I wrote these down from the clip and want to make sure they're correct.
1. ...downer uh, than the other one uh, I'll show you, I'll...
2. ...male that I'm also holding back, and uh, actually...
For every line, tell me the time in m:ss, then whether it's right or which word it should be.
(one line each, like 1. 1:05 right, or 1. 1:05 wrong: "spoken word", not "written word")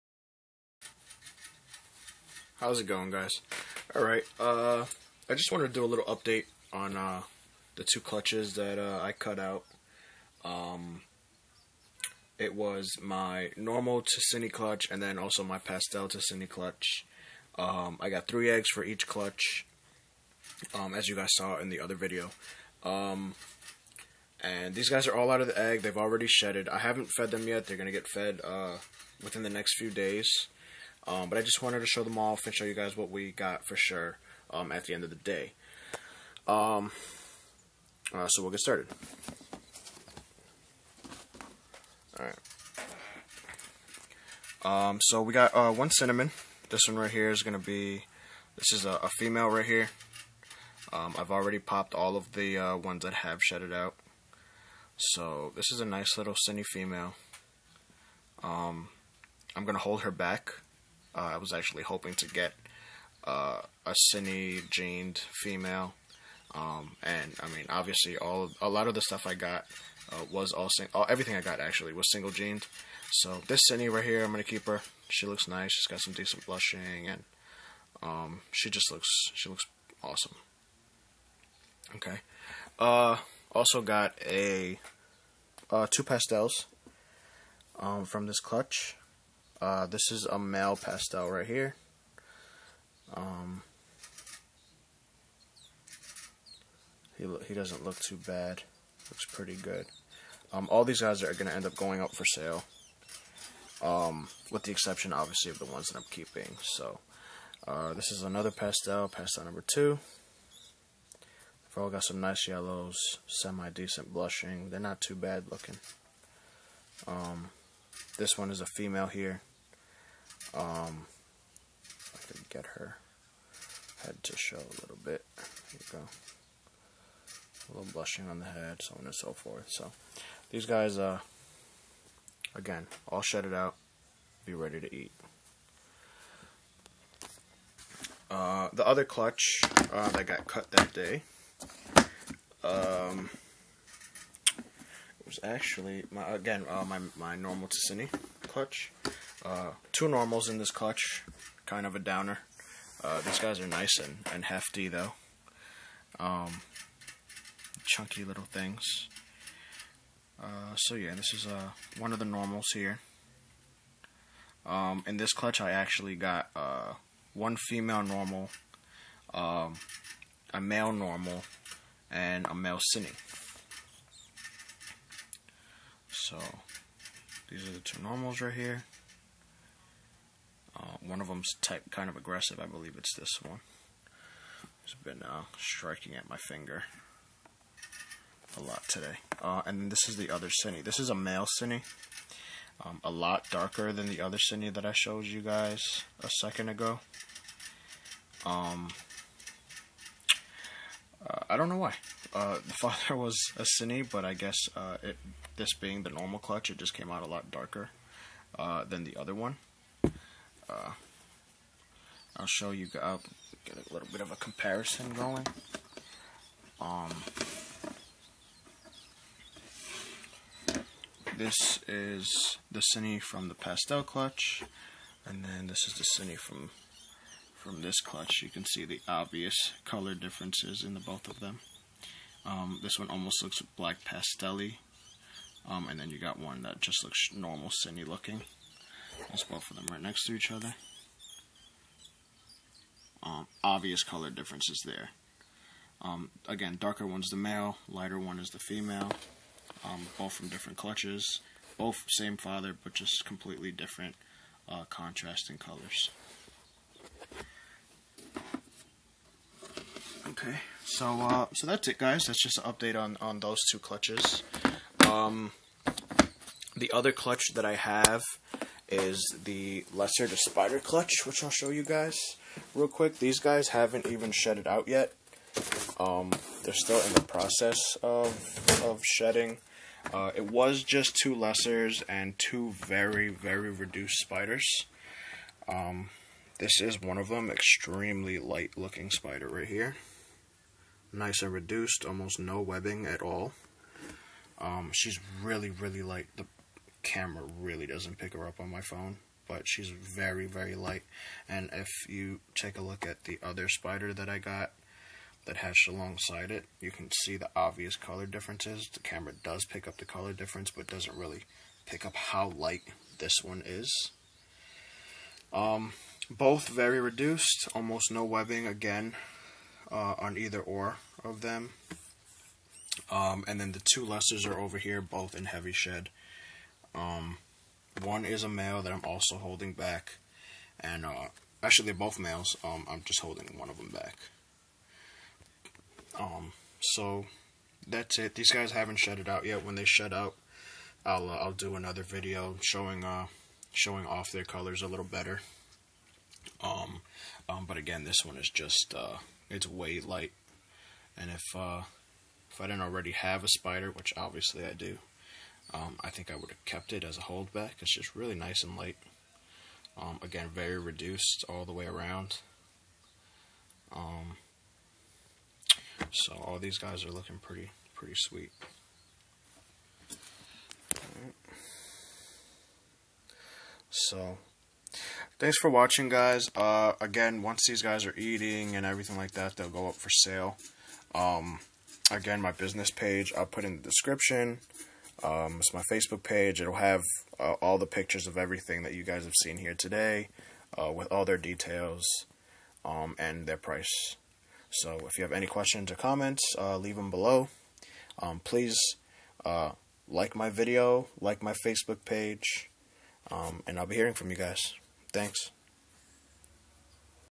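1. 3:27 wrong: "darker", not "downer"
2. 5:28 right.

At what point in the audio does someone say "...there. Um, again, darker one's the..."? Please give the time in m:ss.
4:04.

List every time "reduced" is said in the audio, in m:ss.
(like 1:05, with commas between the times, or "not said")
4:43, 4:51, 5:17, 6:00.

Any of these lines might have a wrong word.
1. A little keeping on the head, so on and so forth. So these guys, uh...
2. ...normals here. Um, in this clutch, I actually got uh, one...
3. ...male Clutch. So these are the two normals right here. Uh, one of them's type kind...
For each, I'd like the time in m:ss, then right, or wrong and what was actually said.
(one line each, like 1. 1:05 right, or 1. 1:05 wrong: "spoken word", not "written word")
1. 2:07 wrong: "blushing", not "keeping"
2. 2:42 right
3. 2:52 wrong: "Cine", not "Clutch".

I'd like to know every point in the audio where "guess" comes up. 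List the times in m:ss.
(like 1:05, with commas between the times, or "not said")
3:24.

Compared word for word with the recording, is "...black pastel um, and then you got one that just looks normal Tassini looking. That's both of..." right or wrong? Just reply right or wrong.
wrong.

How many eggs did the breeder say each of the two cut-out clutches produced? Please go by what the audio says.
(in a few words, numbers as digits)
3.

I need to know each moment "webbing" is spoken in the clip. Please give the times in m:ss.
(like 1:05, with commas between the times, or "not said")
4:52, 5:18.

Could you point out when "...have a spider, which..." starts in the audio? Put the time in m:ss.
5:53.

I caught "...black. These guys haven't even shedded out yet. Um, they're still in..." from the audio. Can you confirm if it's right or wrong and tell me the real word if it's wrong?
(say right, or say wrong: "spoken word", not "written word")
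wrong: "quick", not "black".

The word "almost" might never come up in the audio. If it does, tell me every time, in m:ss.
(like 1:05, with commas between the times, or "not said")
3:53, 4:52, 5:17.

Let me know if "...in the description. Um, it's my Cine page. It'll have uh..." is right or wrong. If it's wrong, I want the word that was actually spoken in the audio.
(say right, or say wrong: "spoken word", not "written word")
wrong: "Facebook", not "Cine".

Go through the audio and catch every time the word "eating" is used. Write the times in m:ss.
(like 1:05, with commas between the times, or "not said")
6:18.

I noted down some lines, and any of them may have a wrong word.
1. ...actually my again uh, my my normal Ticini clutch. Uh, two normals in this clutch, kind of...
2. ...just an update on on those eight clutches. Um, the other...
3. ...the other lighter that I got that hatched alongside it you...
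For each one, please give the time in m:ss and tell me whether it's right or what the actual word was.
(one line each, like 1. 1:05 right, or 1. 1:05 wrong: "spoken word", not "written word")
1. 2:25 right
2. 4:22 wrong: "two", not "eight"
3. 5:03 wrong: "spider", not "lighter".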